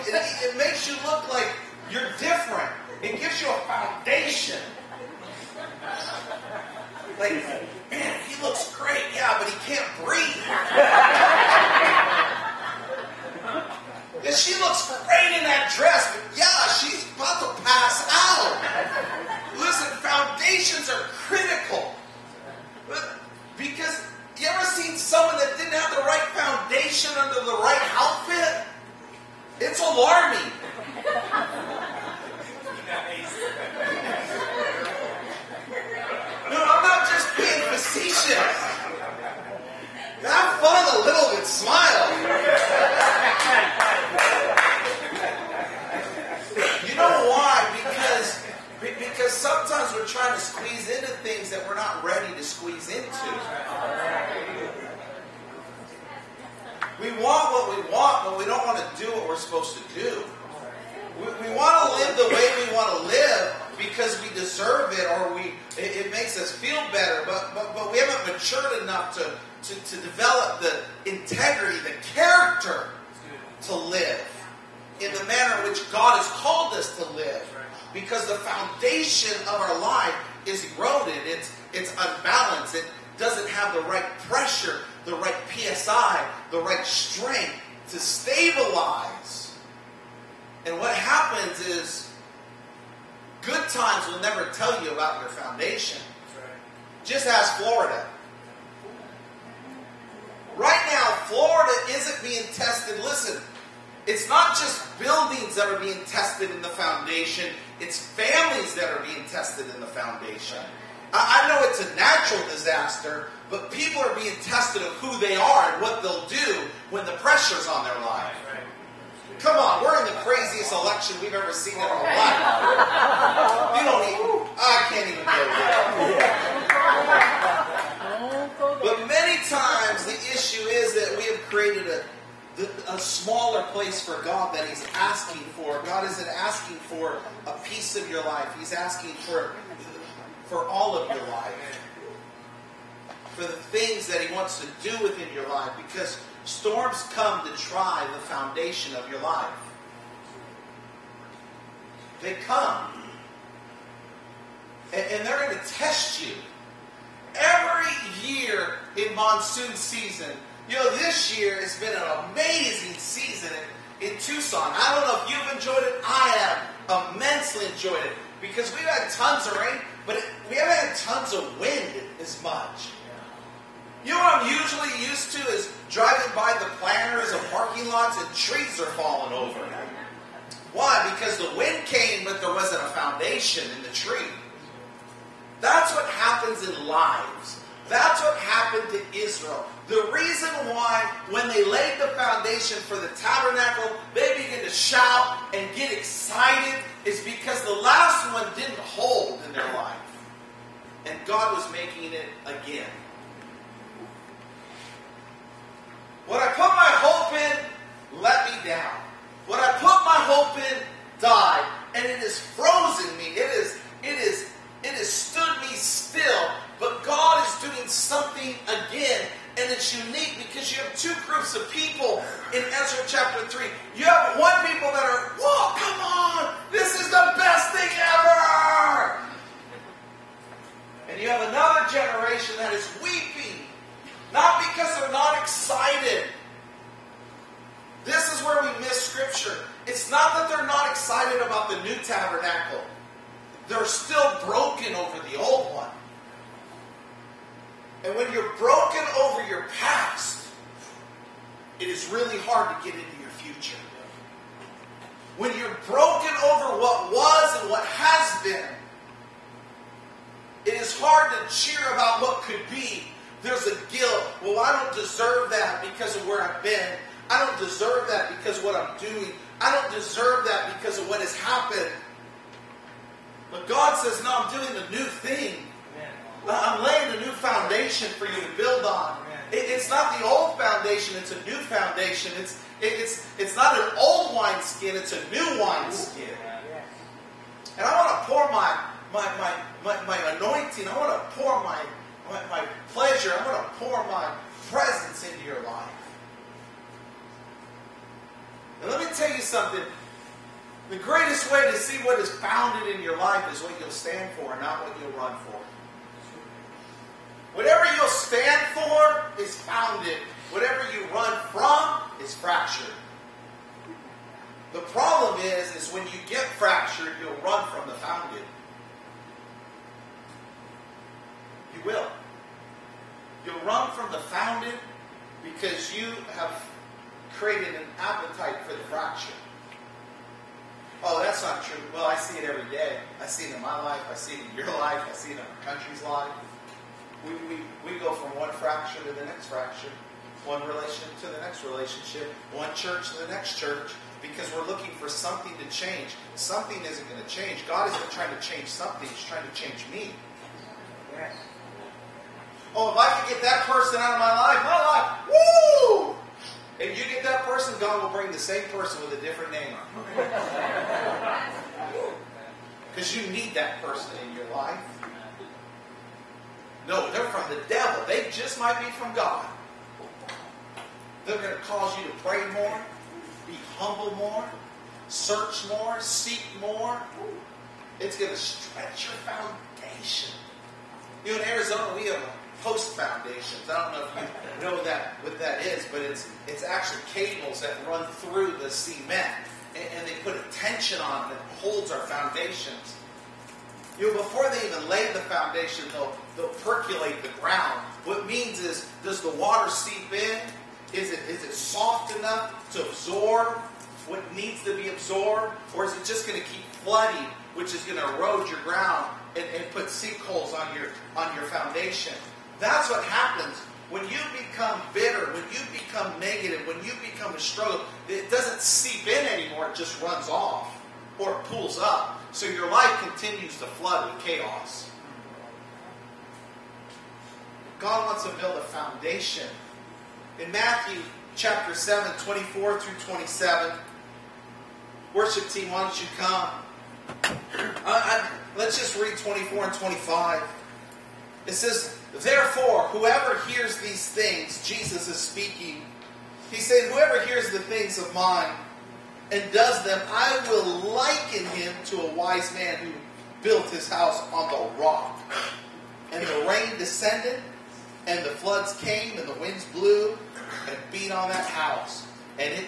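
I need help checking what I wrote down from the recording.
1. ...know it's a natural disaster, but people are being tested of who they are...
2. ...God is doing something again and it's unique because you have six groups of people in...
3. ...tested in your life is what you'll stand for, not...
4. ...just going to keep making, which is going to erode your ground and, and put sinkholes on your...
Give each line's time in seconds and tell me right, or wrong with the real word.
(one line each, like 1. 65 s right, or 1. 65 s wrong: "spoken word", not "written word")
1. 111 s right
2. 217 s wrong: "two", not "six"
3. 302 s wrong: "founded", not "tested"
4. 406 s wrong: "flooding", not "making".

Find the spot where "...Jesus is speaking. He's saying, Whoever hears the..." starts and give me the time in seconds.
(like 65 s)
444 s.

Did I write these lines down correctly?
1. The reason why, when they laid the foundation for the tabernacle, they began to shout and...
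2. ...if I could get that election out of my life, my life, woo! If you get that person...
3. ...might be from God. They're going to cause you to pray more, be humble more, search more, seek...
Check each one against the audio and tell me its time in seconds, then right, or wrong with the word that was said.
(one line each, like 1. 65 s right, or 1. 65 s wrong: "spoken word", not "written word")
1. 189 s right
2. 352 s wrong: "person", not "election"
3. 368 s right.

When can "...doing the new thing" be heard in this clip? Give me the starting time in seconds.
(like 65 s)
274 s.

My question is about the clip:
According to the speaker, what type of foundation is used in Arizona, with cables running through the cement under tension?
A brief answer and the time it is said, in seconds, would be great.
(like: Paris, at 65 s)
post foundations, at 382 s.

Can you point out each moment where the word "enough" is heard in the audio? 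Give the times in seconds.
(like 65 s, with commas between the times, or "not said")
68 s, 402 s.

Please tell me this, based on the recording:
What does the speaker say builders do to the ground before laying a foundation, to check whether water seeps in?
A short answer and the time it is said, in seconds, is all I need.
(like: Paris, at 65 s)
percolate the ground, at 396 s.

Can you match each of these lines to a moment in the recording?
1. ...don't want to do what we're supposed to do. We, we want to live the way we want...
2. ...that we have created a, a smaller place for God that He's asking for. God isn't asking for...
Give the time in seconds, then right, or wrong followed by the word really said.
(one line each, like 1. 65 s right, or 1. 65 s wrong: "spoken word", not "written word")
1. 58 s right
2. 130 s right.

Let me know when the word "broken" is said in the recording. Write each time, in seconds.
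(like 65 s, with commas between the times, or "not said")
244 s, 248 s, 255 s.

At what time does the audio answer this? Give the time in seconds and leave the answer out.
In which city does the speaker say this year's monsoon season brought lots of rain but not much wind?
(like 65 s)
164 s.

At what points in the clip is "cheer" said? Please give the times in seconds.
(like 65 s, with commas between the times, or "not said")
261 s.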